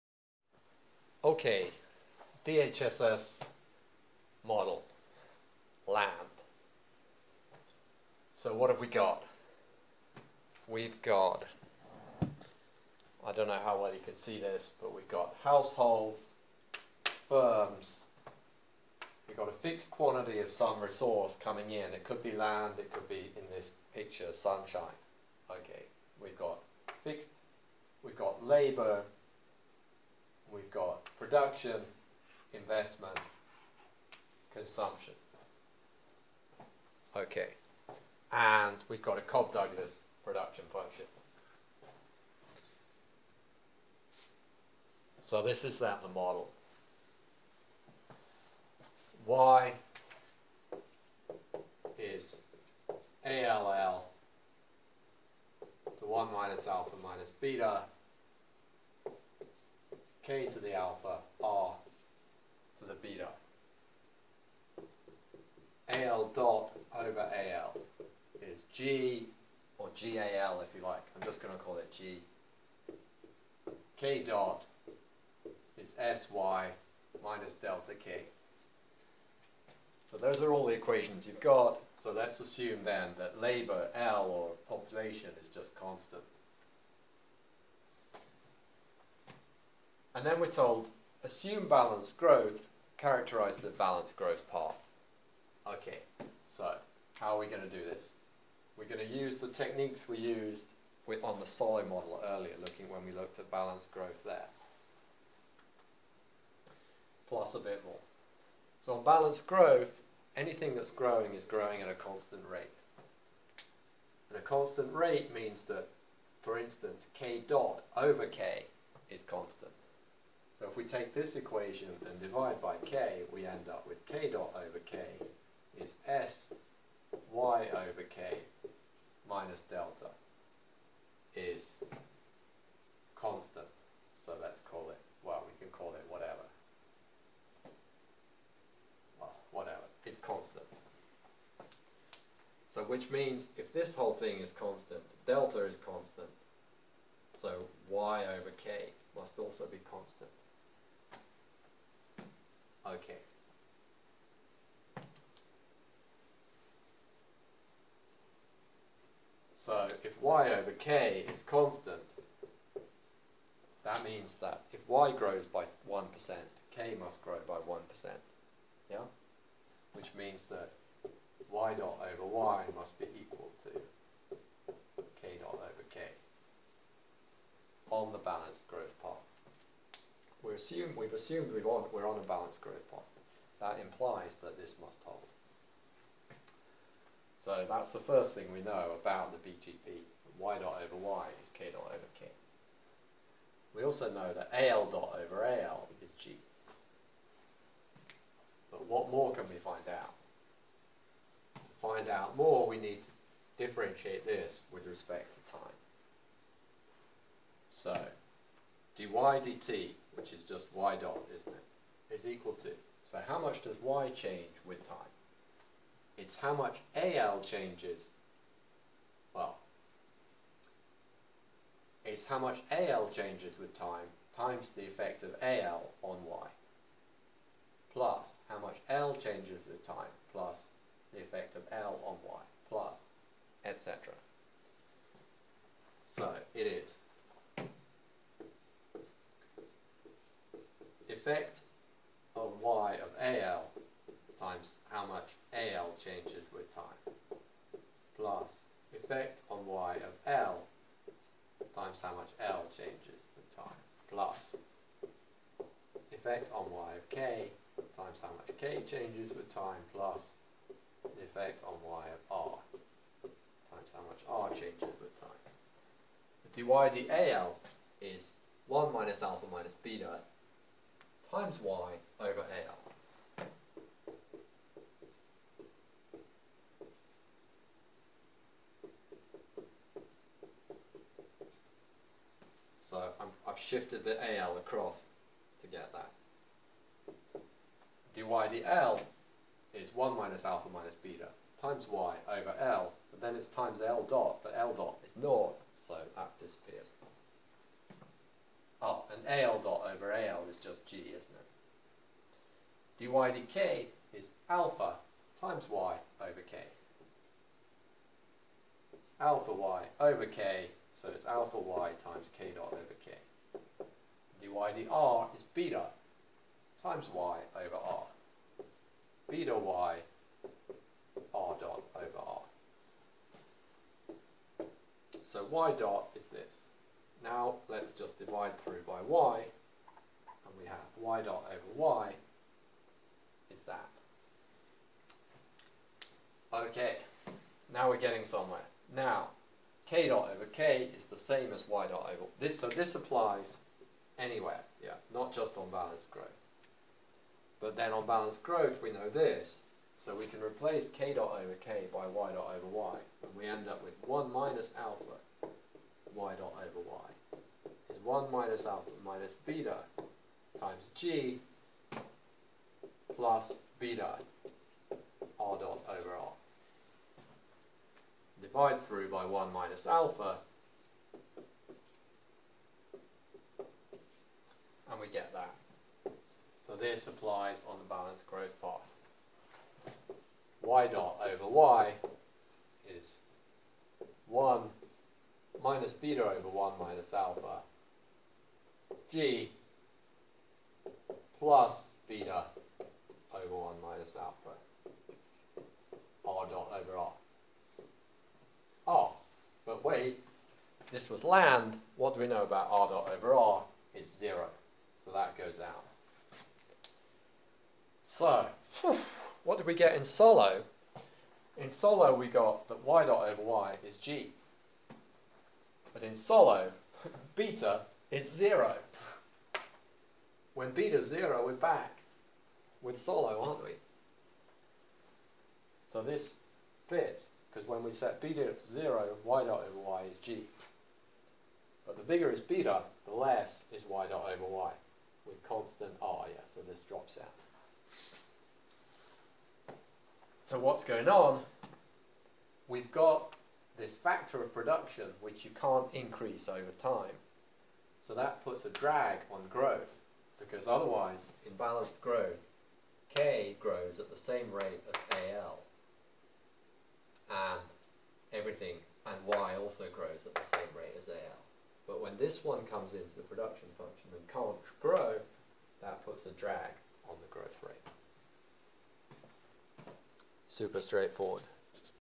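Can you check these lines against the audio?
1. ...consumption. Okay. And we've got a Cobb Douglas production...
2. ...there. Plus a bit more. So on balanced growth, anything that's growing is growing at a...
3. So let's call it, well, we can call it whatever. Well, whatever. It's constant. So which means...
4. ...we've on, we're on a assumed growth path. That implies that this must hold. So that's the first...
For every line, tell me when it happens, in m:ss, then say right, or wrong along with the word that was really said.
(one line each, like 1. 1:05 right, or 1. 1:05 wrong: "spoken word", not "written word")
1. 0:34 right
2. 1:44 right
3. 2:14 right
4. 3:01 wrong: "balanced", not "assumed".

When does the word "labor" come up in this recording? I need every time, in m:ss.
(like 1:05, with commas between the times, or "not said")
0:28, 1:23.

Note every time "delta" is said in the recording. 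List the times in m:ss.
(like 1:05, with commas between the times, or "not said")
1:17, 2:09, 2:25.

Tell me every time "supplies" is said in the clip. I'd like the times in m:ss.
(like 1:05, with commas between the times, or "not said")
6:17.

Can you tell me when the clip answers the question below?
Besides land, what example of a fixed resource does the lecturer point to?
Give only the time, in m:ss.
0:24.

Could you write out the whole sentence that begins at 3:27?
So, dy dt which is just y dot, isn't it, is equal to.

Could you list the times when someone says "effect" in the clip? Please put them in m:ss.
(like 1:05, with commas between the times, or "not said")
3:44, 3:51, 4:16, 4:21.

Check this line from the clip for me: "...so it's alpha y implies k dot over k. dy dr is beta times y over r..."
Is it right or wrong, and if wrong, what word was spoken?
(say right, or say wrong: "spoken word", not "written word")
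wrong: "times", not "implies".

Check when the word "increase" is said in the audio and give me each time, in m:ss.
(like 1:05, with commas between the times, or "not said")
7:25.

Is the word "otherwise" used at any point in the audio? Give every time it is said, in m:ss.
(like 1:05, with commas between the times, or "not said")
7:30.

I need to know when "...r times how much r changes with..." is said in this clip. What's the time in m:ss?
4:22.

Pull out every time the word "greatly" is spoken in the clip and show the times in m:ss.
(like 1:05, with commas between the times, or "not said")
not said.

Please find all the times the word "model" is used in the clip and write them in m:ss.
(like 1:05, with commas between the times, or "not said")
0:04, 0:46, 1:41.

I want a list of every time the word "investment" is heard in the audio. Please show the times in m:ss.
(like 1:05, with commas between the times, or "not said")
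0:32.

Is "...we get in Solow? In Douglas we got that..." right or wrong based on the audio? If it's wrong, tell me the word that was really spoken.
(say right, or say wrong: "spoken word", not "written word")
wrong: "Solow", not "Douglas".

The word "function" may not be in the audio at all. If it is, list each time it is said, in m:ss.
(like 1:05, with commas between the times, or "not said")
0:40, 7:43.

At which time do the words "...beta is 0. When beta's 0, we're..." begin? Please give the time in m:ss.
6:57.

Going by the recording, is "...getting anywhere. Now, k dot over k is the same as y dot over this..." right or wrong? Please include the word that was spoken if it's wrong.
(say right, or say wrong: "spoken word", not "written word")
wrong: "somewhere", not "anywhere".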